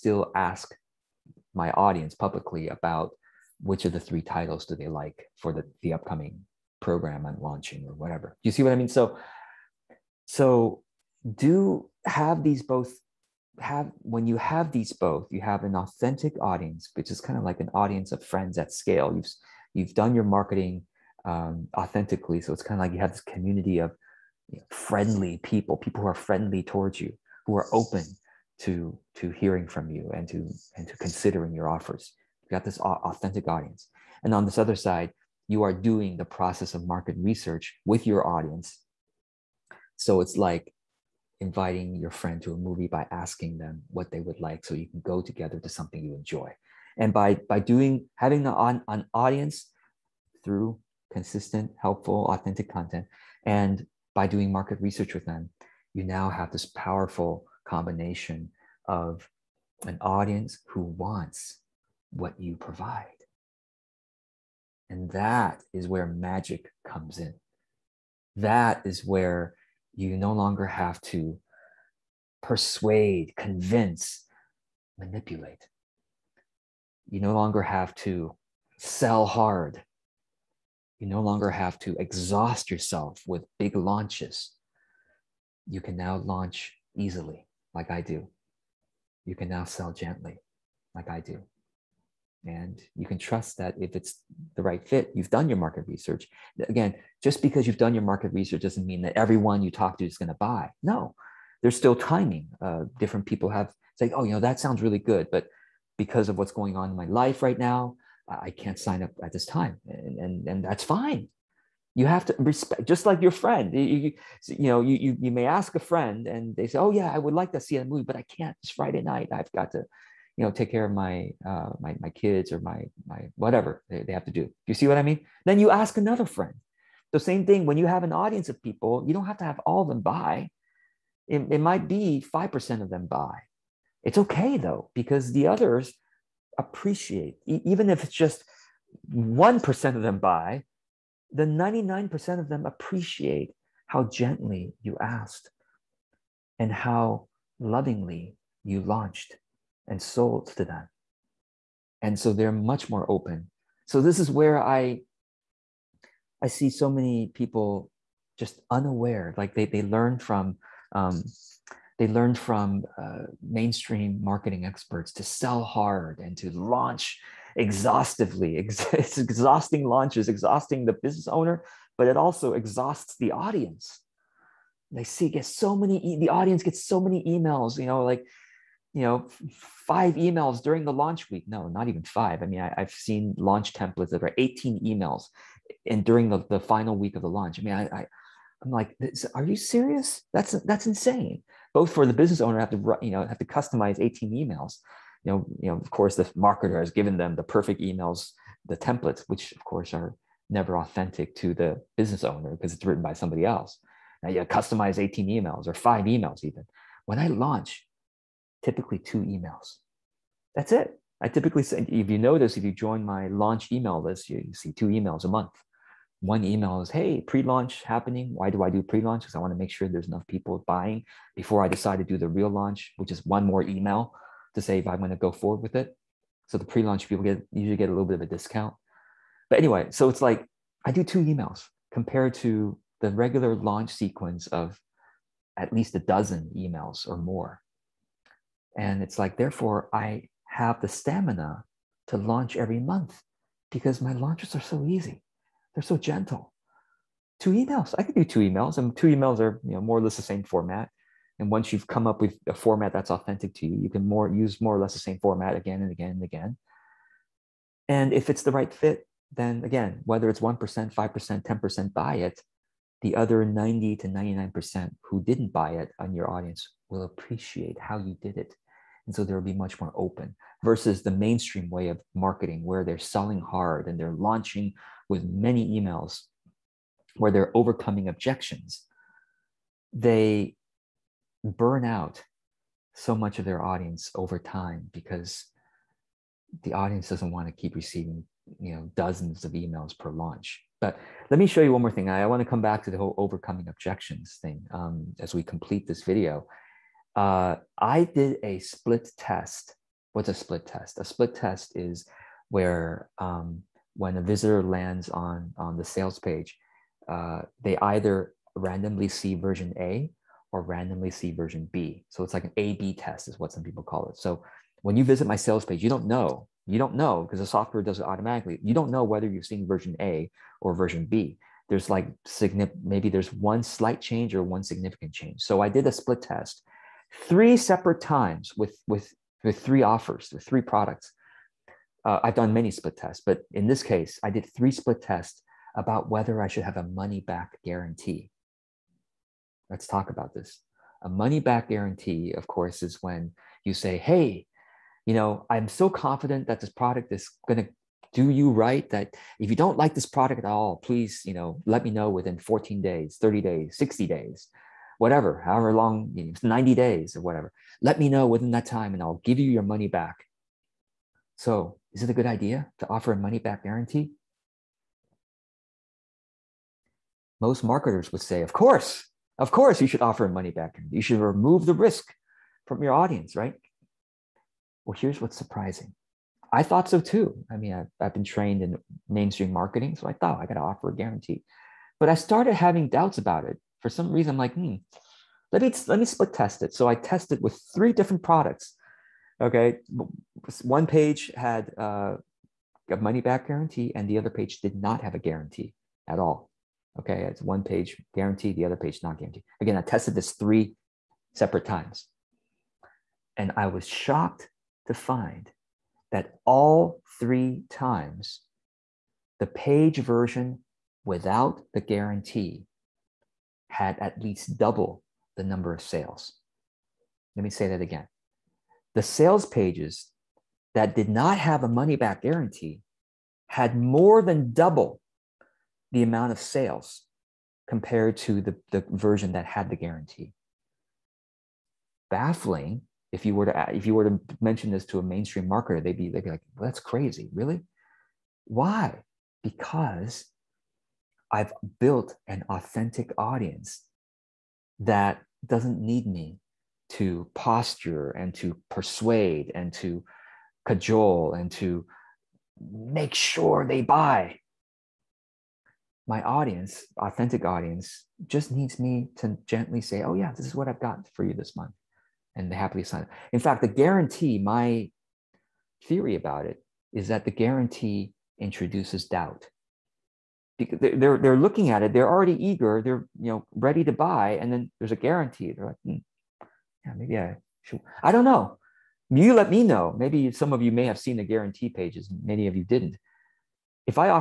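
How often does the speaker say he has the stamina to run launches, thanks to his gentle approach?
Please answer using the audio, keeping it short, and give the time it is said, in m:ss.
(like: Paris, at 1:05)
every month, at 4:02.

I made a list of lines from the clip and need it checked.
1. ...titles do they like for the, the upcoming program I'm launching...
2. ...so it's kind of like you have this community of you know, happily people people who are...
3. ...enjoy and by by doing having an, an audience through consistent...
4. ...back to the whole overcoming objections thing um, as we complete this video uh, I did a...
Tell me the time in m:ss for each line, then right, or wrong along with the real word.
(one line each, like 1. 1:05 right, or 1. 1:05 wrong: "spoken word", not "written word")
1. 0:04 right
2. 0:22 wrong: "friendly", not "happily"
3. 0:46 right
4. 4:52 right.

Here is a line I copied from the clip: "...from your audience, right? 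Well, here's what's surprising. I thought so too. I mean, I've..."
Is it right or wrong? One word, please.
right.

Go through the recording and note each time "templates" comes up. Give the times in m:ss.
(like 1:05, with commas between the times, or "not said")
3:03, 3:18.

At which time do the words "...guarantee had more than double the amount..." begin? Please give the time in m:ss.
7:02.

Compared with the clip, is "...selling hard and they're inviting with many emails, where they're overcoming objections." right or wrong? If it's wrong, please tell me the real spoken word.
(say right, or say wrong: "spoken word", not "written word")
wrong: "launching", not "inviting".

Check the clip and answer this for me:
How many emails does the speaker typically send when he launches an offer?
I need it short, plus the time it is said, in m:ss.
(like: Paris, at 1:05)
2, at 3:28.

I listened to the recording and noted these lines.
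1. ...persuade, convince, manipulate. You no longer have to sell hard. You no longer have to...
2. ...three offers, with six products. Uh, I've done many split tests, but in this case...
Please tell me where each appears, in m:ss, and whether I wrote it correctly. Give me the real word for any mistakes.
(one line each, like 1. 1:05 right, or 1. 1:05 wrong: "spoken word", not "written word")
1. 1:12 right
2. 5:29 wrong: "three", not "six".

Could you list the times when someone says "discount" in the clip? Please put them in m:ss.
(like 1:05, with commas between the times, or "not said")
3:48.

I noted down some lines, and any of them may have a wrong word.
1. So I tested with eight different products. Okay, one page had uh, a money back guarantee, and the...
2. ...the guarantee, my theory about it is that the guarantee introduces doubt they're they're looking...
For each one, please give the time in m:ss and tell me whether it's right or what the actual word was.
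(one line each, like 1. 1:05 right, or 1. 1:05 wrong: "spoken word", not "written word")
1. 6:26 wrong: "three", not "eight"
2. 7:43 right.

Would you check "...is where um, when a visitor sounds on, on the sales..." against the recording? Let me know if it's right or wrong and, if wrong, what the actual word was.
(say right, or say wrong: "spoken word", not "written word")
wrong: "lands", not "sounds".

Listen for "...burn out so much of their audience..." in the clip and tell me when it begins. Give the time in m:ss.
4:41.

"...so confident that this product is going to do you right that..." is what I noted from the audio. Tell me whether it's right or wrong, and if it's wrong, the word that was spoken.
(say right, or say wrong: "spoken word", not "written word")
right.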